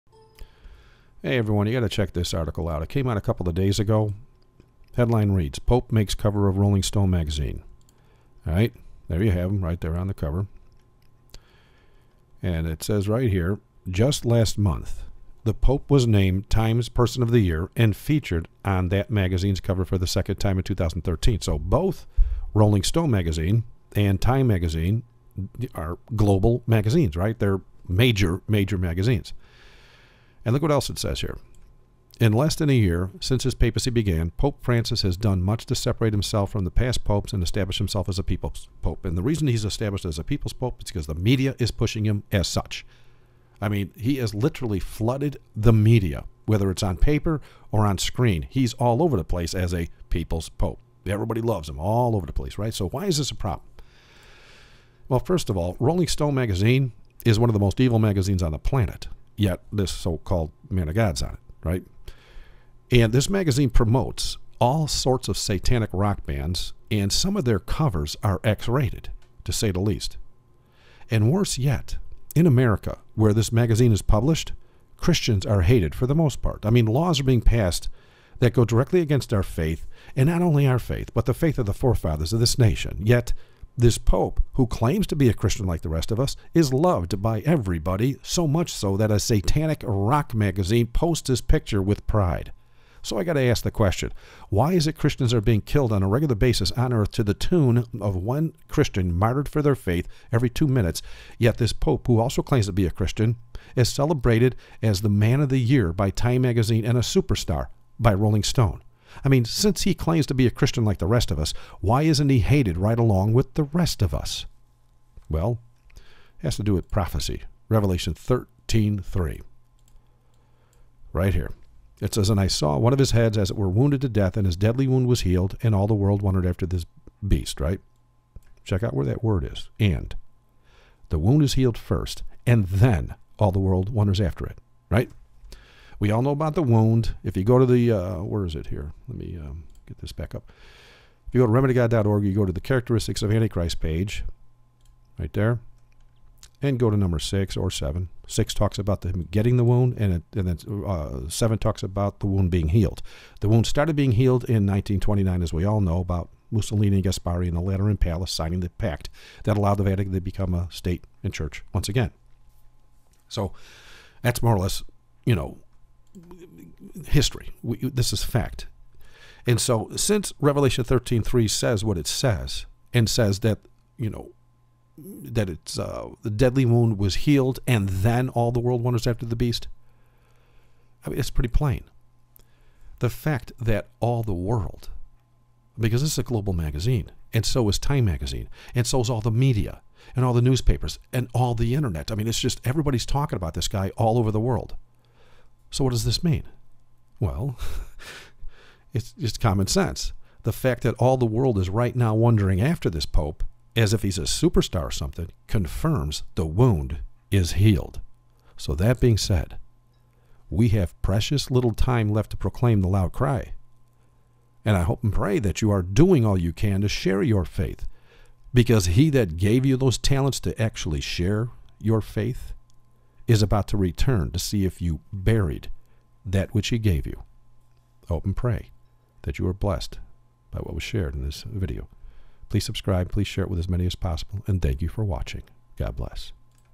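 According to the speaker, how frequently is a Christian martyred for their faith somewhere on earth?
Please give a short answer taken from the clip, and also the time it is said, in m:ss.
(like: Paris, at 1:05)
every 2 minutes, at 1:40.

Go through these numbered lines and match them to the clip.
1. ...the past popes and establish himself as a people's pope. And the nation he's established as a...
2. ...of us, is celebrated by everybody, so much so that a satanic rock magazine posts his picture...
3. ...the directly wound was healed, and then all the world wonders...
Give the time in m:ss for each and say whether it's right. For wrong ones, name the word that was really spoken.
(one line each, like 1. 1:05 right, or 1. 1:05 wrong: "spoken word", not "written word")
1. 0:36 wrong: "reason", not "nation"
2. 1:26 wrong: "loved", not "celebrated"
3. 2:56 wrong: "deadly", not "directly".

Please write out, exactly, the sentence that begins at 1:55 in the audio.
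Well, it has to do with prophecy.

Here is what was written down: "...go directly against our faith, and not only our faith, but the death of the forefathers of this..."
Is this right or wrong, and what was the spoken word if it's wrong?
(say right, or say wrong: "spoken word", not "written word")
wrong: "faith", not "death".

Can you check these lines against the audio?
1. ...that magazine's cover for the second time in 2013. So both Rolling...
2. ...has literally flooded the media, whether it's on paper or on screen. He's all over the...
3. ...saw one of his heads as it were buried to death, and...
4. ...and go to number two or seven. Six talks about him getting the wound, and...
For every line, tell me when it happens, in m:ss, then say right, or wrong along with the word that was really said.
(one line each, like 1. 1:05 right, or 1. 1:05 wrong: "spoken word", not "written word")
1. 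0:18 right
2. 0:44 right
3. 2:02 wrong: "wounded", not "buried"
4. 2:26 wrong: "six", not "two".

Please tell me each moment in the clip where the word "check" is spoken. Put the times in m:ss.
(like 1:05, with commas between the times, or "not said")
0:01, 2:08.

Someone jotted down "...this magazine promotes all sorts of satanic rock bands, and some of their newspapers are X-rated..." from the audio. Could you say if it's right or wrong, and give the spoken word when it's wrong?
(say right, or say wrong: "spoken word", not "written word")
wrong: "covers", not "newspapers".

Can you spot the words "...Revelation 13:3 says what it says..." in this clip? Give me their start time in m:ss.
2:50.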